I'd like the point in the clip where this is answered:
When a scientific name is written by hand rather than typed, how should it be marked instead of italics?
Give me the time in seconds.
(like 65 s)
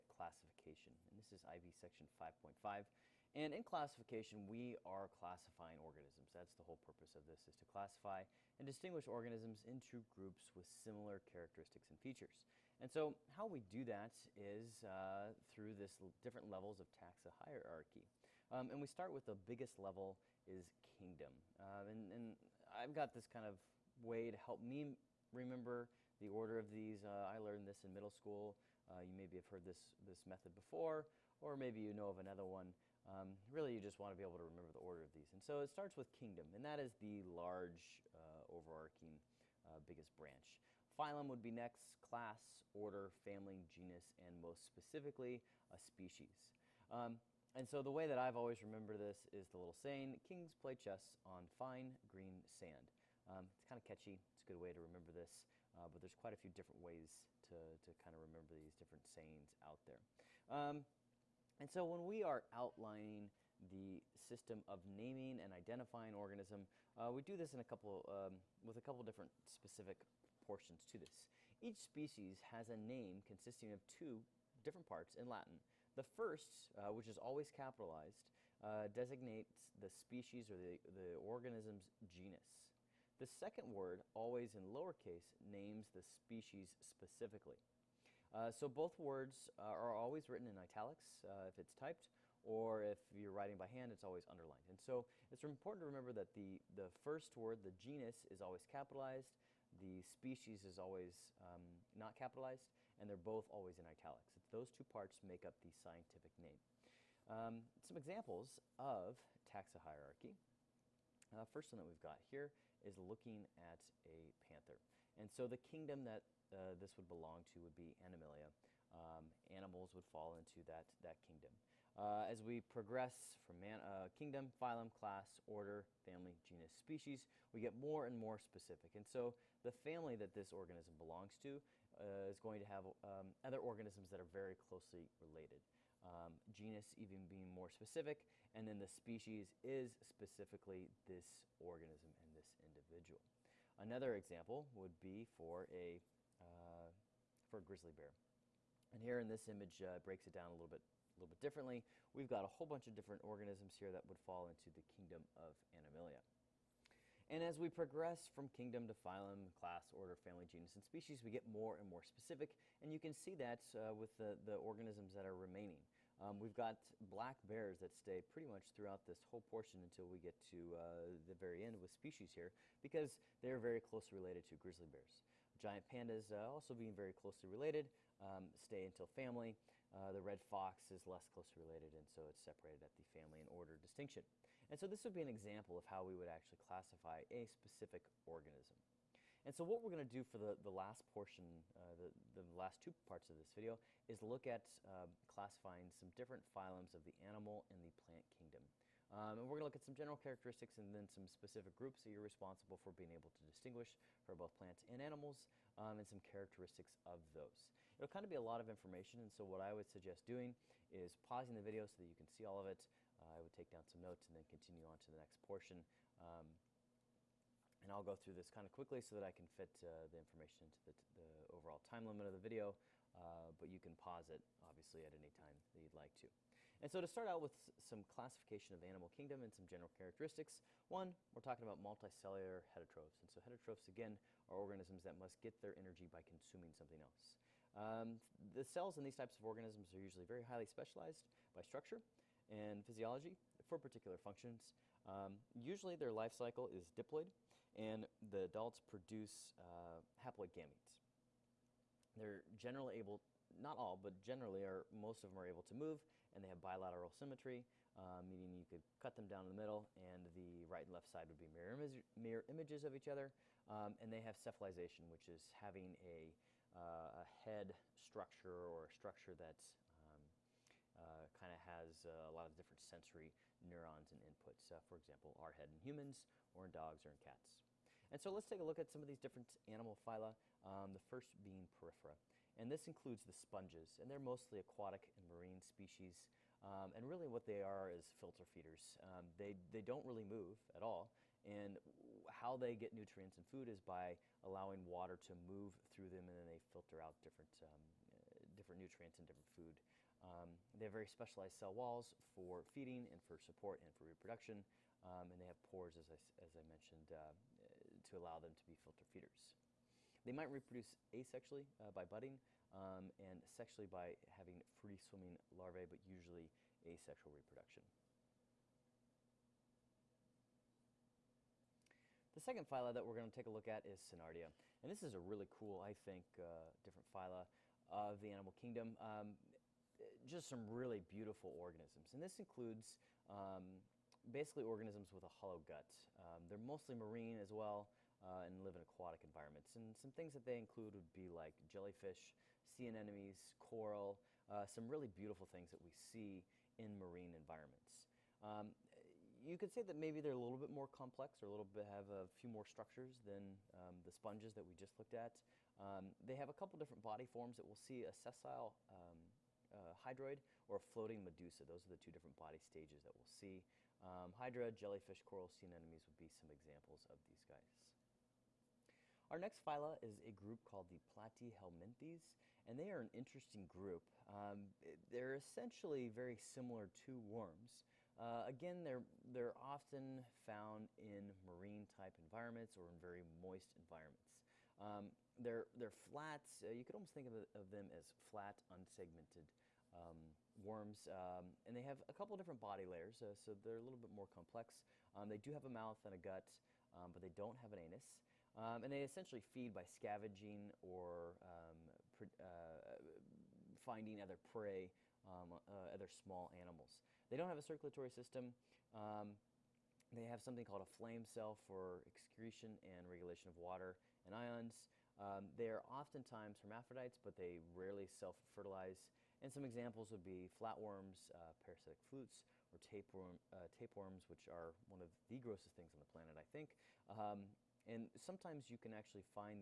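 94 s.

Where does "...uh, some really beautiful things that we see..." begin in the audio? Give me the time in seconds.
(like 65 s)
344 s.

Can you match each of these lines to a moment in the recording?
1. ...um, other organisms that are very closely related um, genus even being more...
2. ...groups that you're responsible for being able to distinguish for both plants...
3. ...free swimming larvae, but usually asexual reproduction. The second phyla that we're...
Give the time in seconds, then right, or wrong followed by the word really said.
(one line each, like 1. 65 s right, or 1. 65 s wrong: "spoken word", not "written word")
1. 133 s right
2. 201 s right
3. 314 s right.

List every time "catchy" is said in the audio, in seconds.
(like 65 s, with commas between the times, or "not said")
53 s.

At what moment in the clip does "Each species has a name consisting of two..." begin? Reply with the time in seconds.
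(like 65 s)
71 s.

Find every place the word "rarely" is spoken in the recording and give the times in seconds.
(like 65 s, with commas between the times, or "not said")
417 s.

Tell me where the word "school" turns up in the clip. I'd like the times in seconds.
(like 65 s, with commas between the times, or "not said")
28 s.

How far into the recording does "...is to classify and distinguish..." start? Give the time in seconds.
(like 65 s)
7 s.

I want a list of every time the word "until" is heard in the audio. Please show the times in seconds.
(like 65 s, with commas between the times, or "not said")
169 s, 178 s.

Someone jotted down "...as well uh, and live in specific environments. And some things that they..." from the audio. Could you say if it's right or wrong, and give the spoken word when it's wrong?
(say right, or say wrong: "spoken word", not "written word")
wrong: "aquatic", not "specific".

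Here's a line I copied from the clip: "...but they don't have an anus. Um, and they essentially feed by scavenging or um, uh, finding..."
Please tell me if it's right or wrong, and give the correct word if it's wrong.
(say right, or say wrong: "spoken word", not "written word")
right.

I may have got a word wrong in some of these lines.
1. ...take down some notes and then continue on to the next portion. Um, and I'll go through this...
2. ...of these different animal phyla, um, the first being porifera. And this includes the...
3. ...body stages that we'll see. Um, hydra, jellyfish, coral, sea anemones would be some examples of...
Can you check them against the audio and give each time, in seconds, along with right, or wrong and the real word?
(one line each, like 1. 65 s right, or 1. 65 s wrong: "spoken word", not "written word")
1. 213 s right
2. 279 s right
3. 362 s right.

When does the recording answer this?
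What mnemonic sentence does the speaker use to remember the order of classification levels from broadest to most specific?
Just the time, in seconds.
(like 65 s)
50 s.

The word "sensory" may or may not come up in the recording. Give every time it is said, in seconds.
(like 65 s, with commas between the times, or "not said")
272 s.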